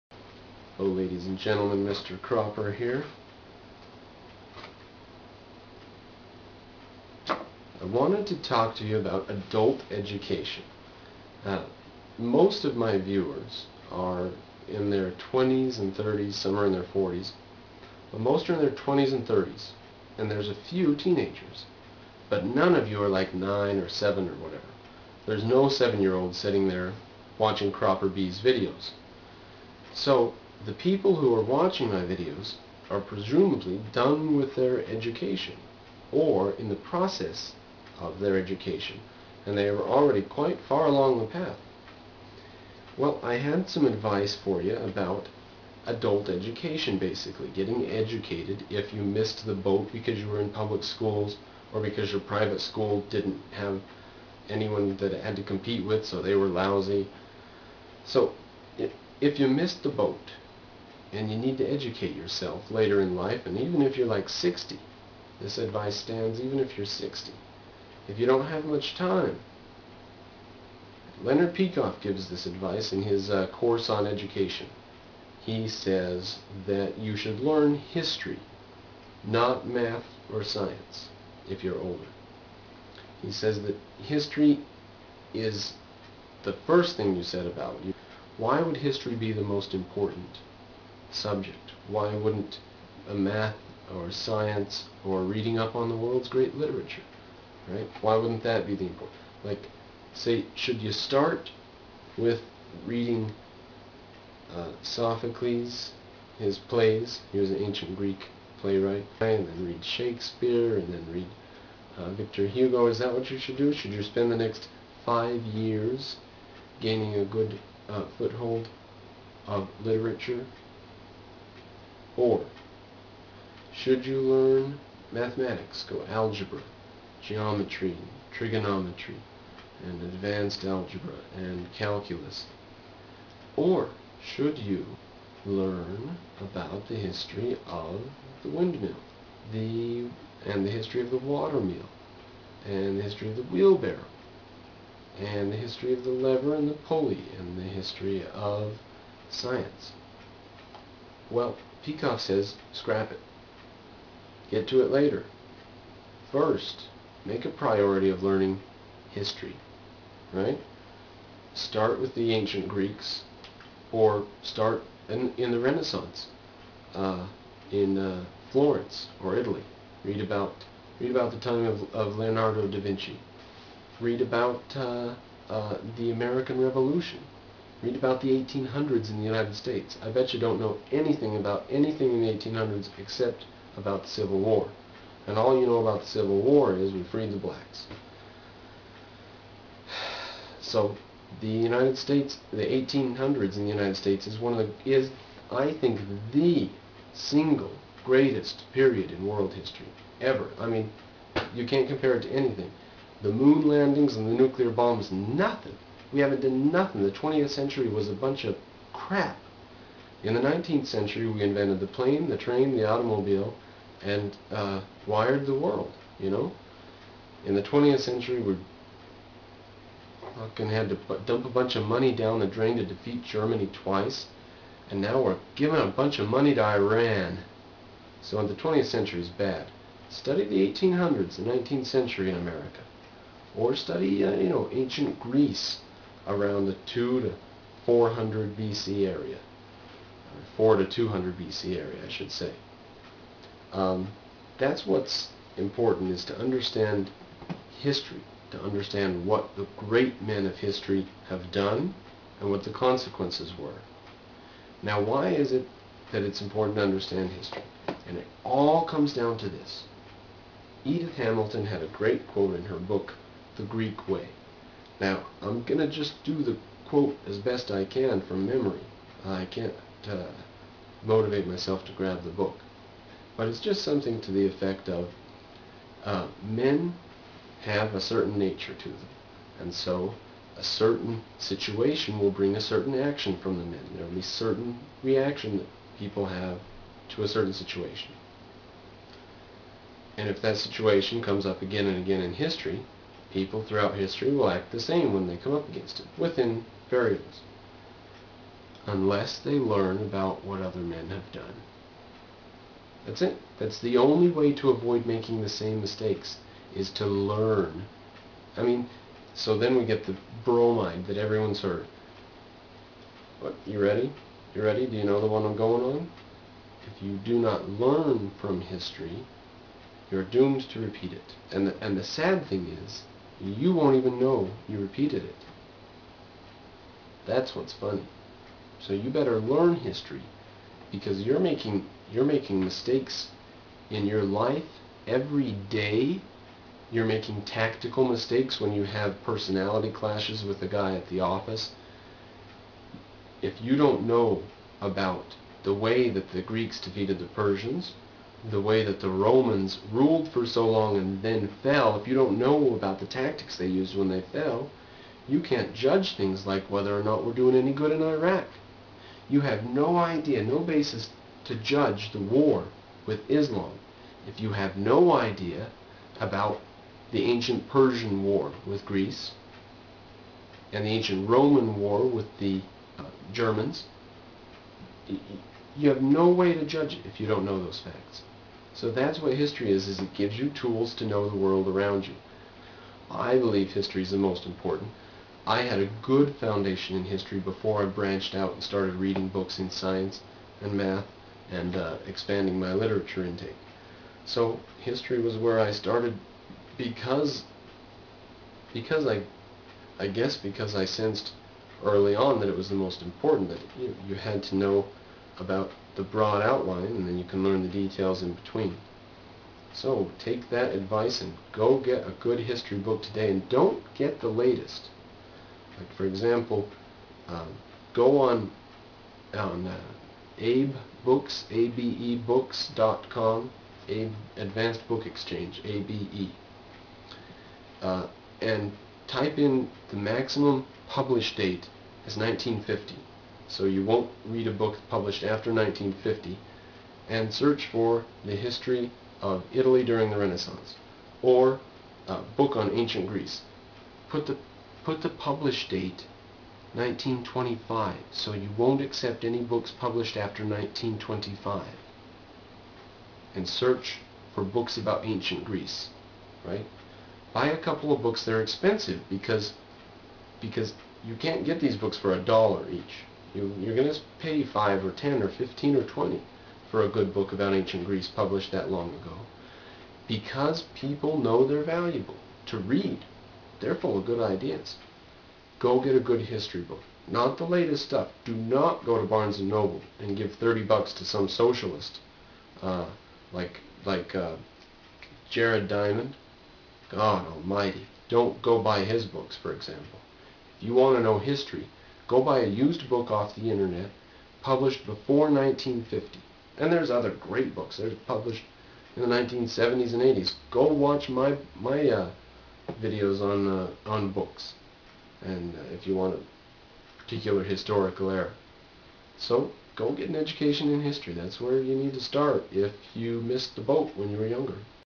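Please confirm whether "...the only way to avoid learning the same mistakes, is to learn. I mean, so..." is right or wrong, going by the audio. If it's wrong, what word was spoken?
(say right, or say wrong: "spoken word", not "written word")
wrong: "making", not "learning".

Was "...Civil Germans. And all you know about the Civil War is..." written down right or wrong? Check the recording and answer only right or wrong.
wrong.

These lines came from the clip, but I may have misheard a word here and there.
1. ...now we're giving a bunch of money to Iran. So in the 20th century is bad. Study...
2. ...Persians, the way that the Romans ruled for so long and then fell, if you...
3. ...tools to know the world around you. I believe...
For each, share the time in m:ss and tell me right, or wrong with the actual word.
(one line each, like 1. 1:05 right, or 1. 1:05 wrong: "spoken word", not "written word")
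1. 3:44 right
2. 5:47 right
3. 6:20 right.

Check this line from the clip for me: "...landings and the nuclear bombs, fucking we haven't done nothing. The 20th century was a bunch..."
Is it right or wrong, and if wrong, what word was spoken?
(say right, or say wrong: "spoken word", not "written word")
wrong: "nothing", not "fucking".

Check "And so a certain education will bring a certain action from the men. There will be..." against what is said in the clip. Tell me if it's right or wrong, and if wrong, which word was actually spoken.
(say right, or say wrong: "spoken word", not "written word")
wrong: "situation", not "education".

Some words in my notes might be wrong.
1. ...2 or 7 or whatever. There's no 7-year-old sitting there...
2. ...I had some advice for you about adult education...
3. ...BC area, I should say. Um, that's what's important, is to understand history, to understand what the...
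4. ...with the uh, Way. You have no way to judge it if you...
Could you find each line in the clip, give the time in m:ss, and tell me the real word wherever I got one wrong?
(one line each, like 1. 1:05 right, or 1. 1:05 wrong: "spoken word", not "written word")
1. 0:23 wrong: "9", not "2"
2. 0:43 right
3. 4:01 right
4. 6:12 wrong: "Germans", not "Way".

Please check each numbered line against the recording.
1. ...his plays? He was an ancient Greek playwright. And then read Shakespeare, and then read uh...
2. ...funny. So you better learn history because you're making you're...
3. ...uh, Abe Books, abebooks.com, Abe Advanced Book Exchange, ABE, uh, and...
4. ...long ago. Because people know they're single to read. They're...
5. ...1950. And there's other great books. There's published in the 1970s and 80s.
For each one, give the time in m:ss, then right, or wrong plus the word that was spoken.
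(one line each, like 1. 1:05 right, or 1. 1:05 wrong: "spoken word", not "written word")
1. 1:46 right
2. 5:27 right
3. 6:59 right
4. 7:48 wrong: "valuable", not "single"
5. 8:15 right.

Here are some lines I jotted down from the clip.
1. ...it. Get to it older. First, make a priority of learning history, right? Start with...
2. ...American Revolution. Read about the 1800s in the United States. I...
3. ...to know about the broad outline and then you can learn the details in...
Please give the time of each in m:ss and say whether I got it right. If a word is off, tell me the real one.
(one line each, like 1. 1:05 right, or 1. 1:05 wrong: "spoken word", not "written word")
1. 2:33 wrong: "later", not "older"
2. 2:56 right
3. 6:44 right.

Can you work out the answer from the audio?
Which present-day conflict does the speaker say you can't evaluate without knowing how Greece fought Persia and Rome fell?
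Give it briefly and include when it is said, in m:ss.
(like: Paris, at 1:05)
Iraq, at 5:58.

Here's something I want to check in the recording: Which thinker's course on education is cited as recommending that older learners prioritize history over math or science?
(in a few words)
Leonard Peikoff.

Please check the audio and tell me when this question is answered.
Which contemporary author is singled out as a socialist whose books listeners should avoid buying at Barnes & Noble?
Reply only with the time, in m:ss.
8:05.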